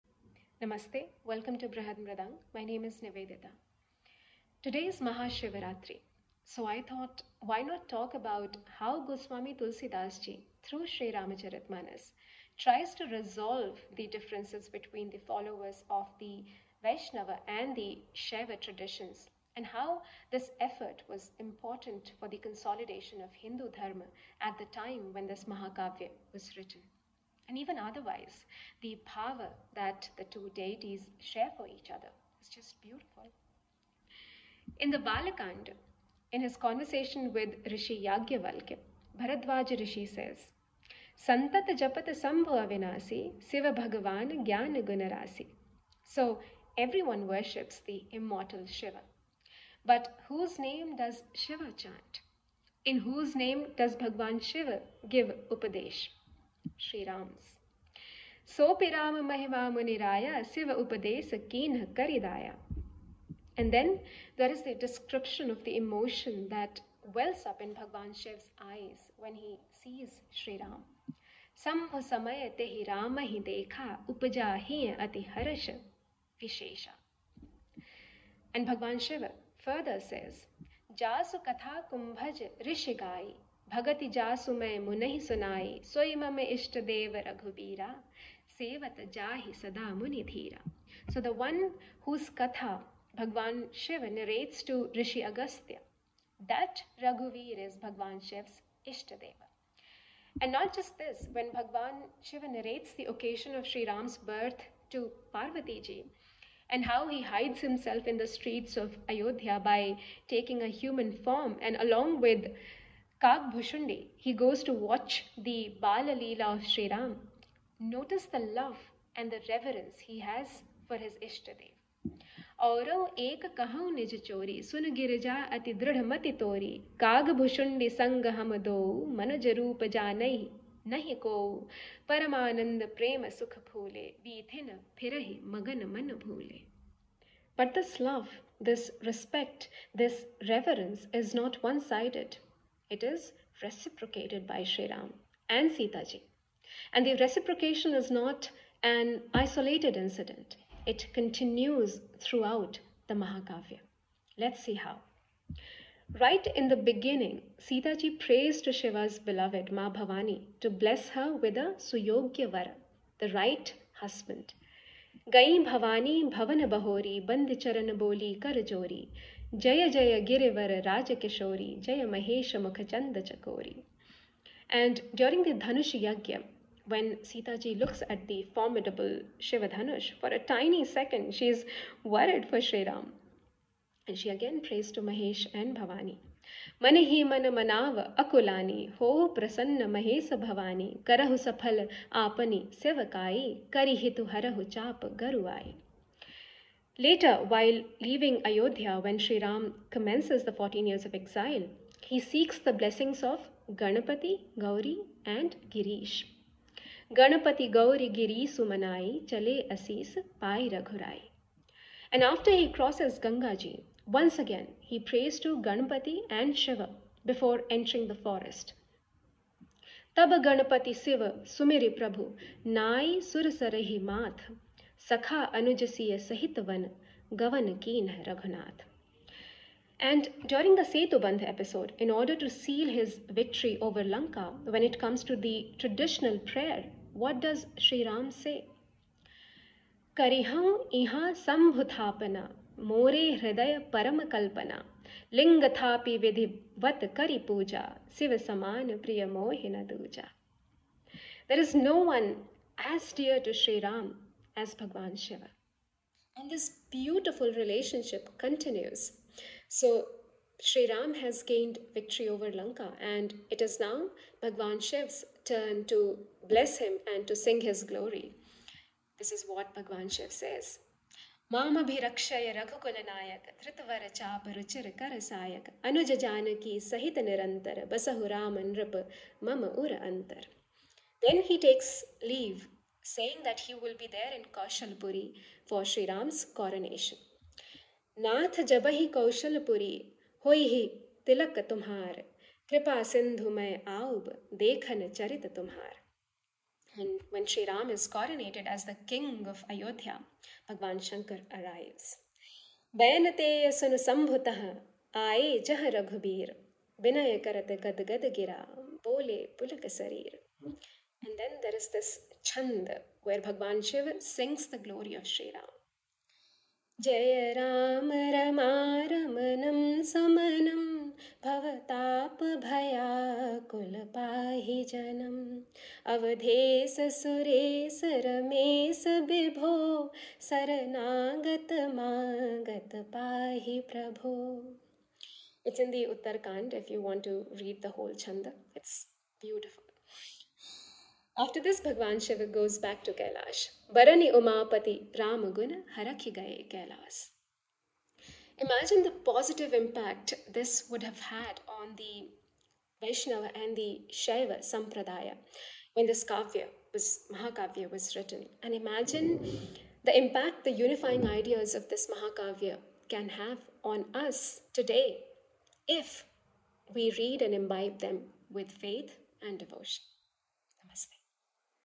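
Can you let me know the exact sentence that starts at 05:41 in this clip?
After this, Bhagwan Shiva goes back to Kailash.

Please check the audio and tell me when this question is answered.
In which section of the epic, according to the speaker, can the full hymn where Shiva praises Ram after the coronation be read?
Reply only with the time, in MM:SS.
05:36.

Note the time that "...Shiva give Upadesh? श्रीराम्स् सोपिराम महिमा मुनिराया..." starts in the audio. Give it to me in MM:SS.
00:54.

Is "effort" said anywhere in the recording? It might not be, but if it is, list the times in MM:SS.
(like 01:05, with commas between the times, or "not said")
00:20.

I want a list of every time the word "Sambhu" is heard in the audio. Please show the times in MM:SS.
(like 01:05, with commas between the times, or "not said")
00:42.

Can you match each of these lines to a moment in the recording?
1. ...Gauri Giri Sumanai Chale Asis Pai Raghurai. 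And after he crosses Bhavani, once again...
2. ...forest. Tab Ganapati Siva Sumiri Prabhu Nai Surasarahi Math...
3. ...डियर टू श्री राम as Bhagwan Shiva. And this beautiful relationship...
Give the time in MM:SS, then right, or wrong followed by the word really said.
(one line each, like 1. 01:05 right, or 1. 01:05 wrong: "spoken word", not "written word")
1. 03:27 wrong: "Gangaji", not "Bhavani"
2. 03:38 right
3. 04:13 right.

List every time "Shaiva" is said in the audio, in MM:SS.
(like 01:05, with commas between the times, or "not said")
00:18, 05:54.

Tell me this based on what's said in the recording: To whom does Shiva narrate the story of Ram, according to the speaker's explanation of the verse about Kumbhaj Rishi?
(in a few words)
Rishi Agastya.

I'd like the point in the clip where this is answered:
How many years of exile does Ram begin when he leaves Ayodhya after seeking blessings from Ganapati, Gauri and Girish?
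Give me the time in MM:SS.
03:20.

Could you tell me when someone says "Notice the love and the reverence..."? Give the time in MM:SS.
01:57.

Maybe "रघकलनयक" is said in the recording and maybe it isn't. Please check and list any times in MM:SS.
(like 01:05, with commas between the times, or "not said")
04:32.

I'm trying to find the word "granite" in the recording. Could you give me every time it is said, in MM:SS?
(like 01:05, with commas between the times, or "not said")
not said.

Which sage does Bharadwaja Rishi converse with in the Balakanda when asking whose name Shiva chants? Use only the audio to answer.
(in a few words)
Yagyavalkya.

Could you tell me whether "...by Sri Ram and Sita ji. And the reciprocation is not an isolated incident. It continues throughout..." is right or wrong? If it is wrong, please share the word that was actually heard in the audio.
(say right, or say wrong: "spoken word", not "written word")
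right.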